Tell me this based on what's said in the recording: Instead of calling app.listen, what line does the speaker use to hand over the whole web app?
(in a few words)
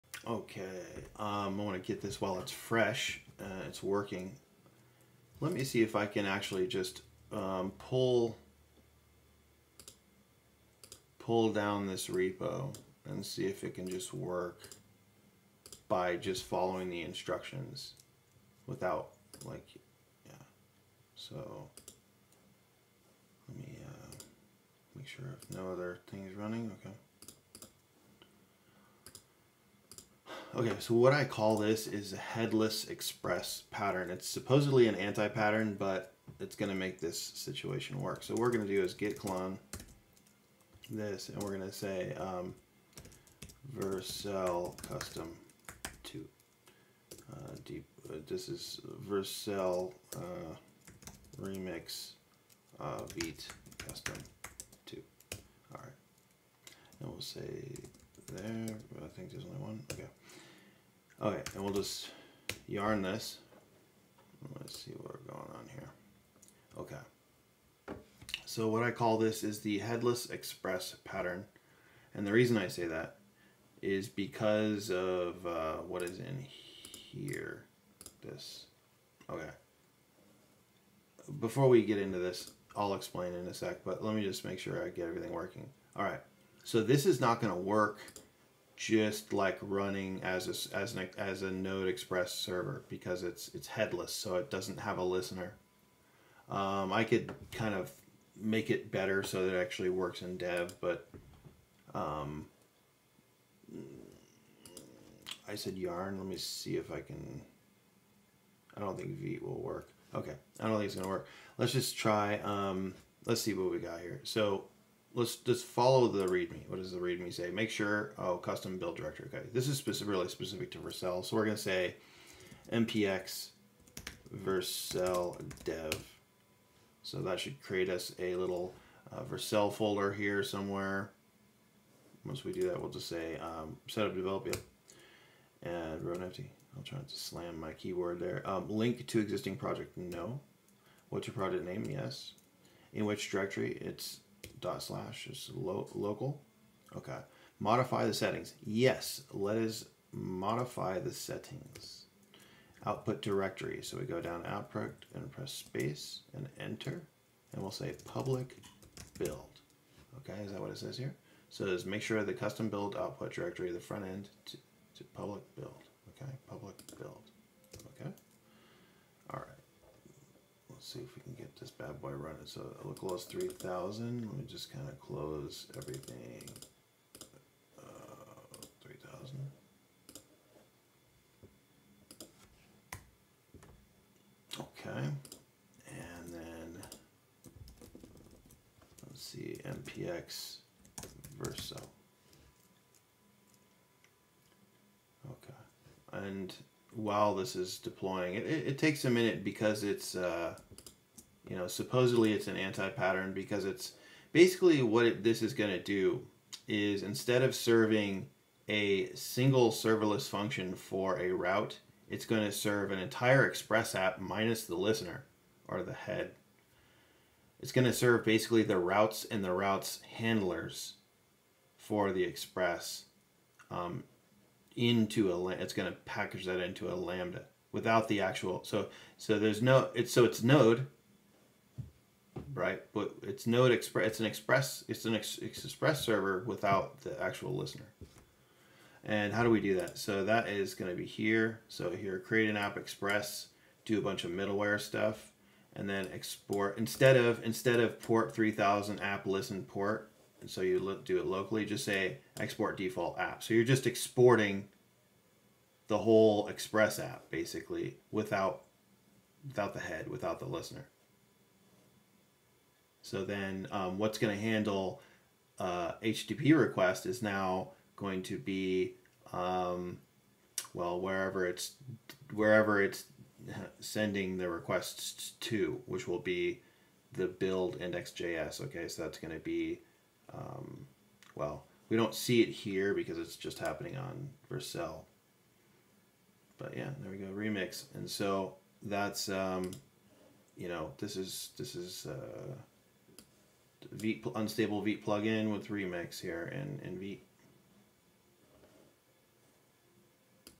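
export default app.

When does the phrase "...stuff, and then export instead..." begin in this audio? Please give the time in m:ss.
4:04.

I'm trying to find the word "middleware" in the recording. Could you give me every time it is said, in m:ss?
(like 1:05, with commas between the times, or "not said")
4:04.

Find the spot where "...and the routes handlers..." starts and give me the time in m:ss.
3:39.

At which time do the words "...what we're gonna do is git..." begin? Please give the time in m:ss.
0:38.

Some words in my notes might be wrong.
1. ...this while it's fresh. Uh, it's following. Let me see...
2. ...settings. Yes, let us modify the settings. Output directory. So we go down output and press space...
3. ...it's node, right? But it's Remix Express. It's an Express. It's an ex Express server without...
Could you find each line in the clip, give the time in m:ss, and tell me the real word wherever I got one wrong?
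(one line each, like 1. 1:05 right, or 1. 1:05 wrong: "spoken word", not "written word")
1. 0:01 wrong: "working", not "following"
2. 2:28 right
3. 3:50 wrong: "Node", not "Remix".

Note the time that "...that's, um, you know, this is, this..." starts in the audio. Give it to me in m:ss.
4:48.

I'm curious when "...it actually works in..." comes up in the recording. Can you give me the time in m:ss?
1:39.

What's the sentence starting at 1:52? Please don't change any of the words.
Um, let's see what we got here.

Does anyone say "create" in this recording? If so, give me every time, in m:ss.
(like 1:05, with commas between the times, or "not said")
2:07, 4:02.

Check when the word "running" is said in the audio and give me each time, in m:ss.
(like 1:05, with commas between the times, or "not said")
0:26, 1:29, 2:52.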